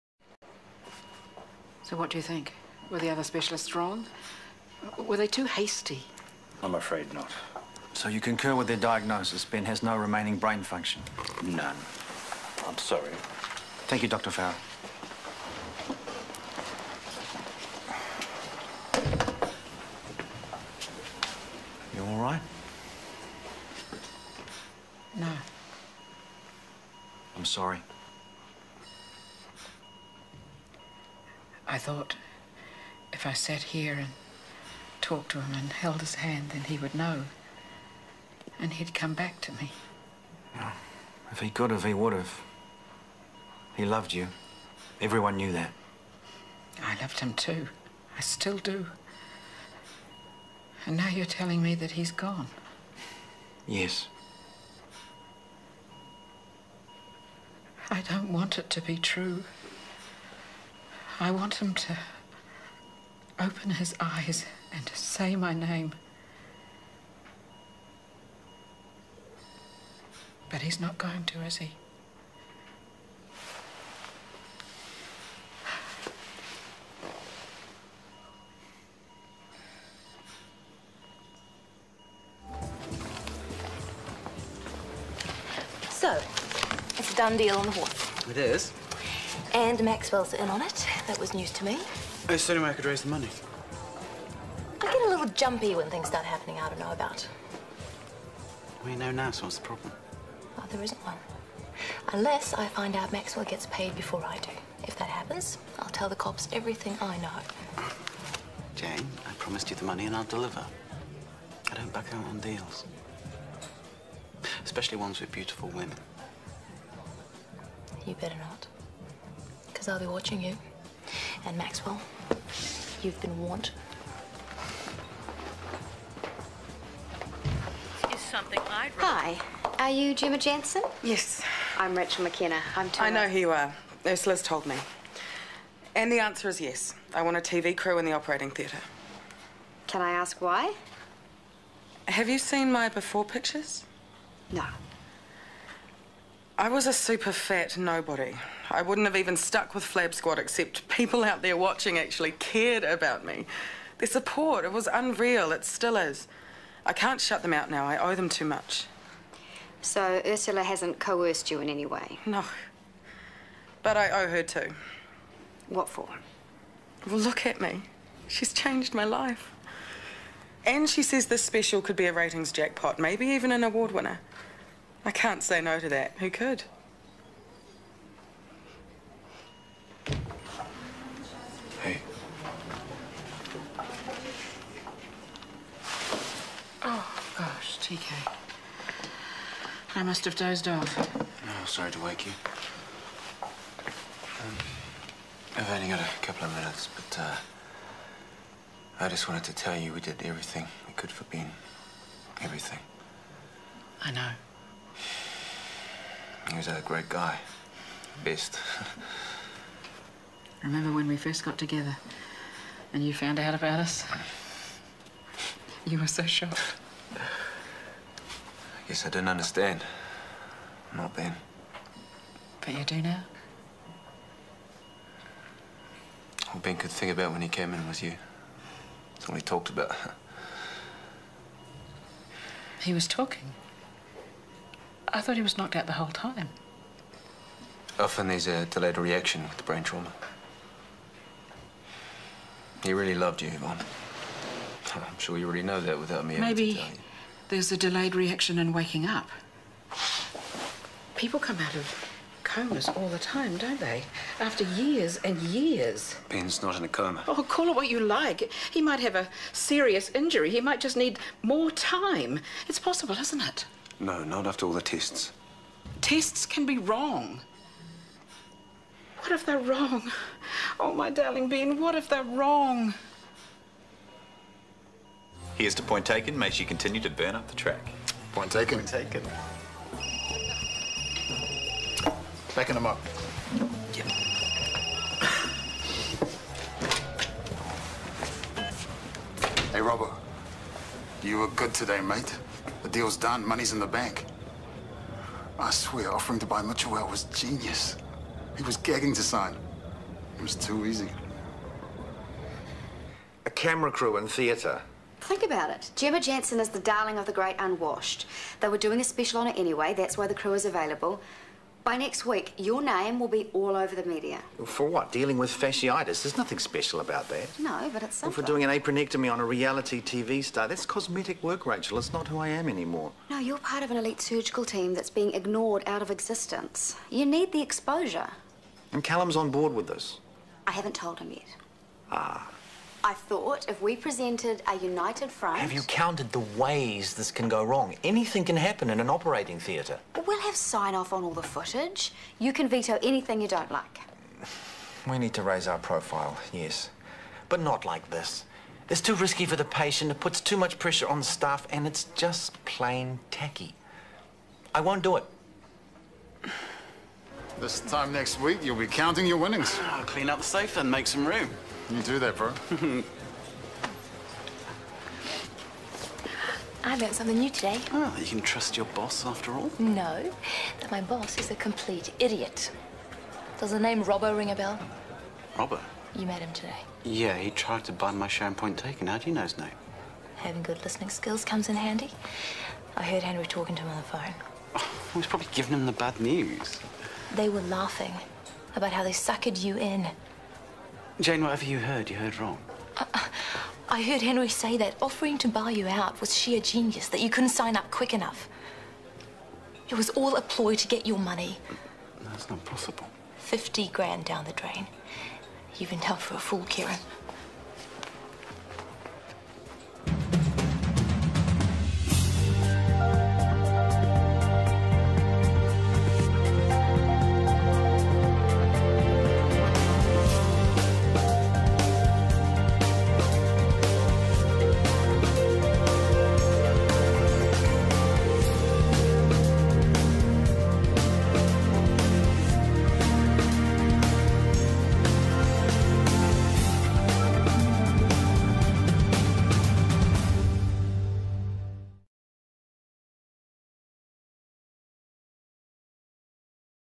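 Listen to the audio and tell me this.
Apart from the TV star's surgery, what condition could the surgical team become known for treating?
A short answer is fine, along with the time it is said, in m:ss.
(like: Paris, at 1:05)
fasciitis, at 5:15.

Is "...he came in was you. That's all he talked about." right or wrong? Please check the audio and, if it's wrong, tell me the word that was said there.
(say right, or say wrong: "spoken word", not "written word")
right.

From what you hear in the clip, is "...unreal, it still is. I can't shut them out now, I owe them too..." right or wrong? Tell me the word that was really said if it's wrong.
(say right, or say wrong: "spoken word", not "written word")
right.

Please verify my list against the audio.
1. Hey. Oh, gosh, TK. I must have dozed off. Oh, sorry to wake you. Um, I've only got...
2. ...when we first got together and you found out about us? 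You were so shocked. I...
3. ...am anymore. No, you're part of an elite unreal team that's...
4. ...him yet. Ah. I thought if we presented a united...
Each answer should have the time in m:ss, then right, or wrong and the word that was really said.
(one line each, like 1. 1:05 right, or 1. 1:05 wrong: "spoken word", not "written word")
1. 3:01 right
2. 3:30 right
3. 5:22 wrong: "surgical", not "unreal"
4. 5:31 right.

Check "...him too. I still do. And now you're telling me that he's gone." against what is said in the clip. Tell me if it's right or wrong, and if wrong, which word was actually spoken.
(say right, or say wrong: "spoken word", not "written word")
right.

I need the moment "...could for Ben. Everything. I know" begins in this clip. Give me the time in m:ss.
3:20.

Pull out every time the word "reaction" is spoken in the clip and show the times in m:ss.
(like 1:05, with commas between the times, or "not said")
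3:58, 4:08.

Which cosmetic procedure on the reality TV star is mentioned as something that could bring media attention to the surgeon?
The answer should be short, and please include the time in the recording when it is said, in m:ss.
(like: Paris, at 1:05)
apronectomy, at 5:18.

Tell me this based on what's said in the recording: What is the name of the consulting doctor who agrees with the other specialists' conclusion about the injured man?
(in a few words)
Dr. Farrell.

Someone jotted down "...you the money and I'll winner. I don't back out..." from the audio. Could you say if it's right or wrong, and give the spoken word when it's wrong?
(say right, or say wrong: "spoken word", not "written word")
wrong: "deliver", not "winner".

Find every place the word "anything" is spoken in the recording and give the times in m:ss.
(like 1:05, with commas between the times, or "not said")
5:38, 5:43.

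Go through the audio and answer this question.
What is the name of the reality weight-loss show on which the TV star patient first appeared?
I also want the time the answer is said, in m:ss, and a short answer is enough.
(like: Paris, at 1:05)
Flab Squad, at 2:29.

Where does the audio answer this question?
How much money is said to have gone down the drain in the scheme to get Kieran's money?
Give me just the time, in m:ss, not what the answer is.
6:43.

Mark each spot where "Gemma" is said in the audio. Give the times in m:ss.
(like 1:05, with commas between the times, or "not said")
2:10, 5:05.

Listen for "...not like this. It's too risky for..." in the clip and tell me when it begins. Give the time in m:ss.
5:47.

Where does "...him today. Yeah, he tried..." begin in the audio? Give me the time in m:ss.
6:16.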